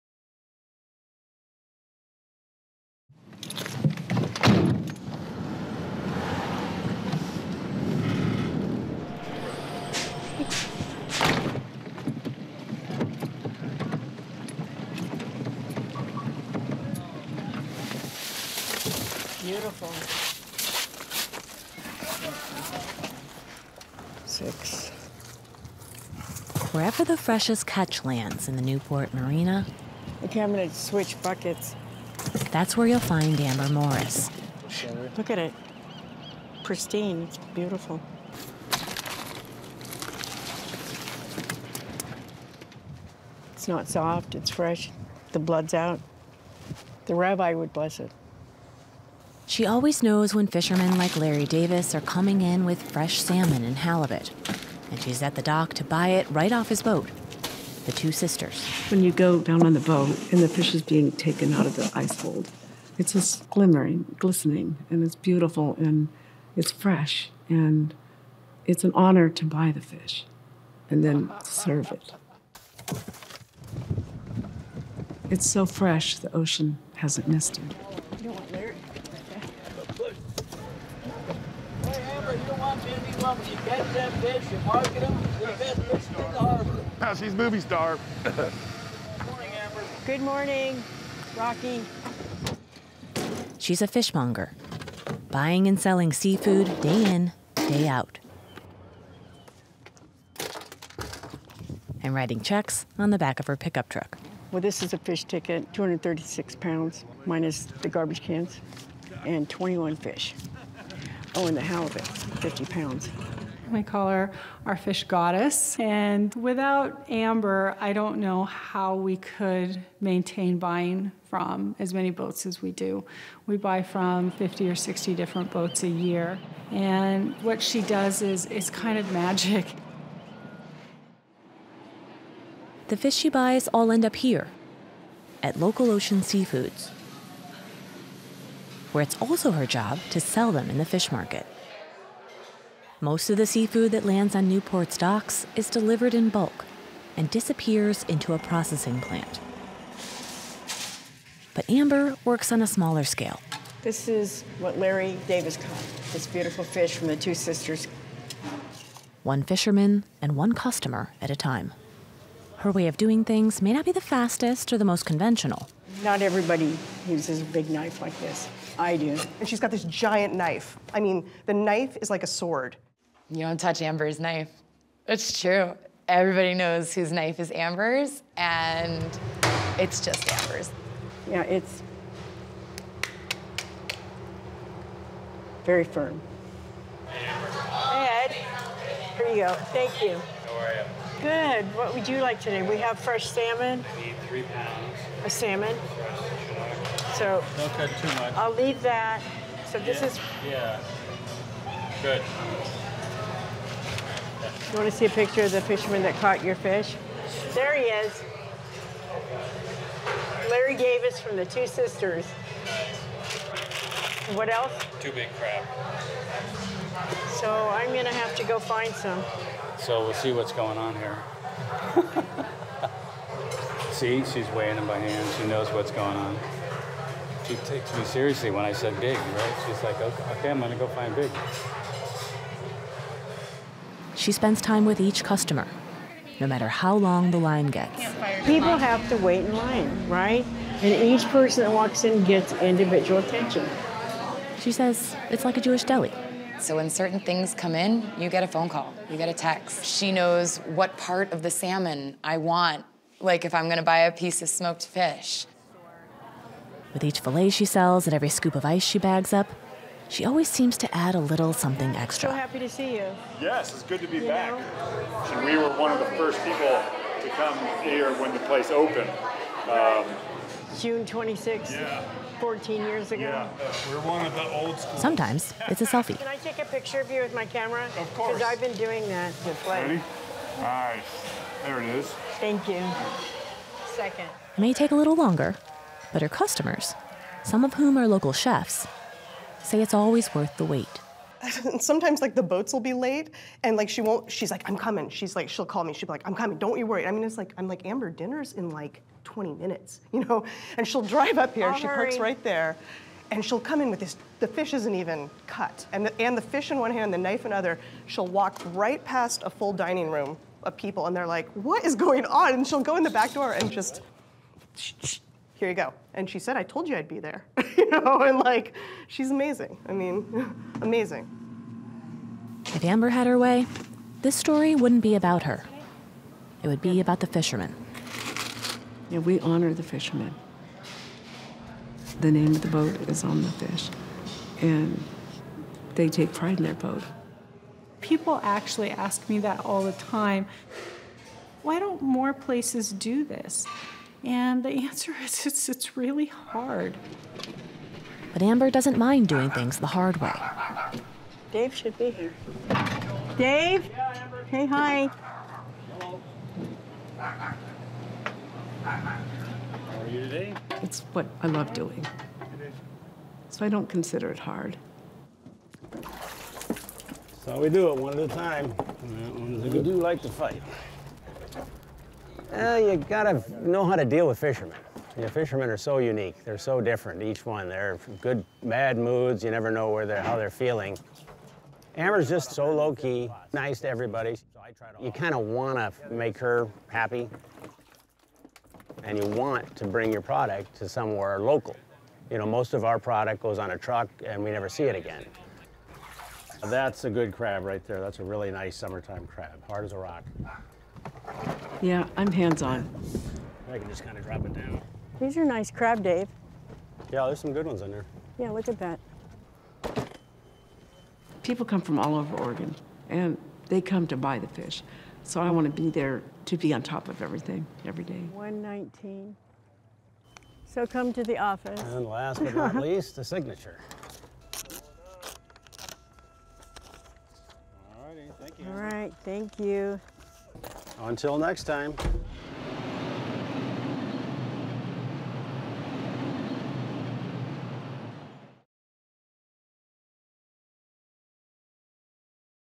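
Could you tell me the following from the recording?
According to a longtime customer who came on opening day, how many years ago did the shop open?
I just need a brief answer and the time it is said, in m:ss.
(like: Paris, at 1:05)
14 years, at 4:32.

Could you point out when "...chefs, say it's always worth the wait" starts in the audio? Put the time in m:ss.
4:48.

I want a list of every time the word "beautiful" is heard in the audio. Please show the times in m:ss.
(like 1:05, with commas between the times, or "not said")
0:19, 0:37, 1:05, 2:36.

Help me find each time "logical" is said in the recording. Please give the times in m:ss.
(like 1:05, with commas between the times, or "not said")
not said.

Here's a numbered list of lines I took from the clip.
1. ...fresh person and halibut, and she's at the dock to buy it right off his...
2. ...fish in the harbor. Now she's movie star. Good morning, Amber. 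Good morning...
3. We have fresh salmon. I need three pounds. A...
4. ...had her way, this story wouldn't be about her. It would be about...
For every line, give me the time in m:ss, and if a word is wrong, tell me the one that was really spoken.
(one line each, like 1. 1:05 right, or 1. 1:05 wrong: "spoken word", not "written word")
1. 0:52 wrong: "salmon", not "person"
2. 1:25 right
3. 3:12 right
4. 5:23 right.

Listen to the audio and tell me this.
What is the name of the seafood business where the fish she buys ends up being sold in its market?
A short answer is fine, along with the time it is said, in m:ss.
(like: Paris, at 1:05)
Local Ocean Seafoods, at 2:15.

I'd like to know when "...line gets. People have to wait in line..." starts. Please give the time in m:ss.
3:57.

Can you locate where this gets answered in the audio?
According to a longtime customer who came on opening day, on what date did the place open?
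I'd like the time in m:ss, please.
4:30.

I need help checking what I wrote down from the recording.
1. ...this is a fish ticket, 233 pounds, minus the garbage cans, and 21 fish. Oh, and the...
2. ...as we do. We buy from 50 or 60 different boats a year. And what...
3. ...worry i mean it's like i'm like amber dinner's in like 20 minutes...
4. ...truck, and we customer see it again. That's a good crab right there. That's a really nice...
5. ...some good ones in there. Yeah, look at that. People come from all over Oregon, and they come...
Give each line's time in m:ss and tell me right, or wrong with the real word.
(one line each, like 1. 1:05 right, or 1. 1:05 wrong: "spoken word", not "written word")
1. 1:44 wrong: "236", not "233"
2. 2:02 right
3. 4:56 right
4. 6:33 wrong: "never", not "customer"
5. 6:47 right.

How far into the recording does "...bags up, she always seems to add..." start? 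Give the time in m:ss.
4:18.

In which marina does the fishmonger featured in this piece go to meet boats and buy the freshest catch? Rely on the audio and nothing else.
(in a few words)
Newport Marina.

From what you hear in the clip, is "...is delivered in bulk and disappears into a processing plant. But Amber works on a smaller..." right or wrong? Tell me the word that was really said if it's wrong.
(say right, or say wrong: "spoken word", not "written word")
right.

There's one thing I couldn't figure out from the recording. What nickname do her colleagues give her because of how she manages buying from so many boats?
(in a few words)
fish goddess.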